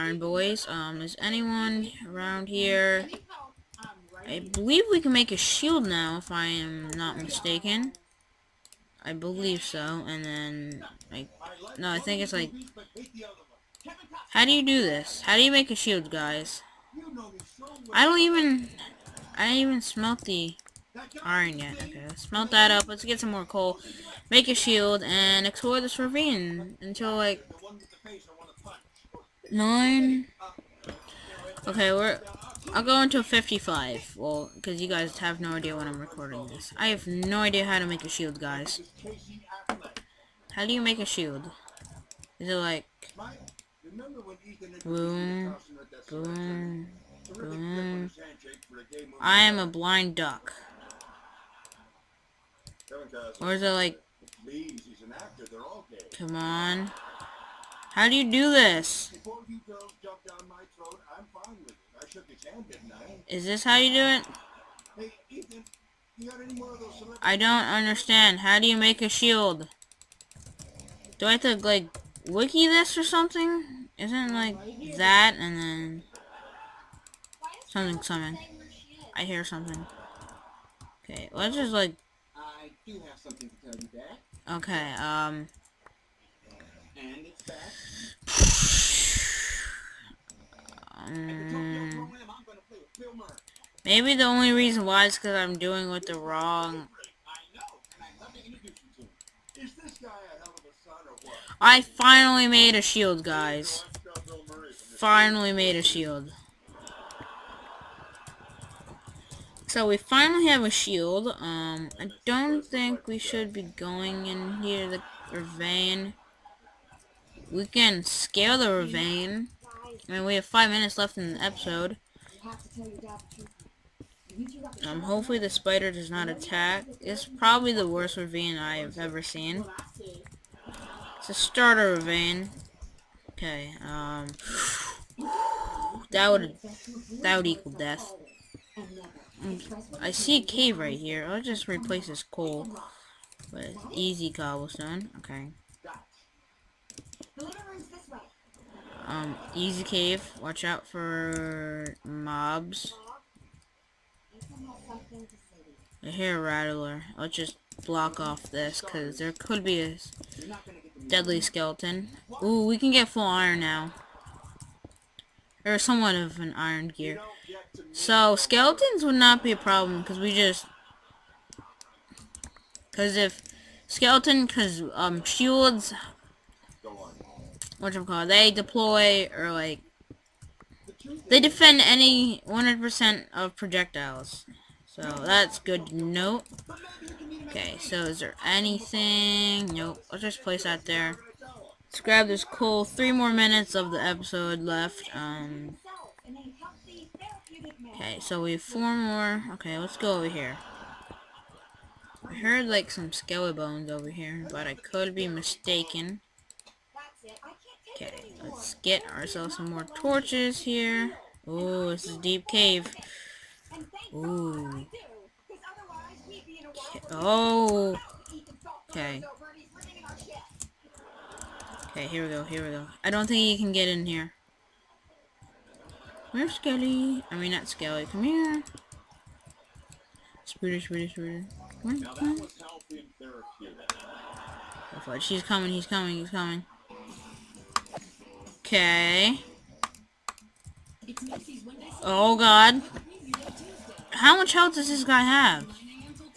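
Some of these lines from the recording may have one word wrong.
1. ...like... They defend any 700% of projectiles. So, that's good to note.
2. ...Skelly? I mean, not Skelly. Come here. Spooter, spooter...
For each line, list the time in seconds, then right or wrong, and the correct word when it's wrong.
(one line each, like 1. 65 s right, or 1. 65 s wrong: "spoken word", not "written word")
1. 179 s wrong: "100", not "700"
2. 226 s right.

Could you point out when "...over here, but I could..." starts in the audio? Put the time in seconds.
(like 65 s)
203 s.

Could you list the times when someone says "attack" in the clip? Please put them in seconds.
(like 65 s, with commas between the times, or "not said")
126 s.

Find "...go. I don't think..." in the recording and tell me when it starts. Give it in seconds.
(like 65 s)
222 s.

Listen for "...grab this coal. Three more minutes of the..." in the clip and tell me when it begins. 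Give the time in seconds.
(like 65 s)
191 s.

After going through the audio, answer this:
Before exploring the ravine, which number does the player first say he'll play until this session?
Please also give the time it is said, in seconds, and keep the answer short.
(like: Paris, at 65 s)
9, at 29 s.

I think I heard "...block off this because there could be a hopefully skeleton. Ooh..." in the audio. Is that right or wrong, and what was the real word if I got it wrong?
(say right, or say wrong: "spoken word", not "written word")
wrong: "deadly", not "hopefully".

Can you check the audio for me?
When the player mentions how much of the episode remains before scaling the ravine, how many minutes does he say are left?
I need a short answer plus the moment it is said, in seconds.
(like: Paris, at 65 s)
5, at 120 s.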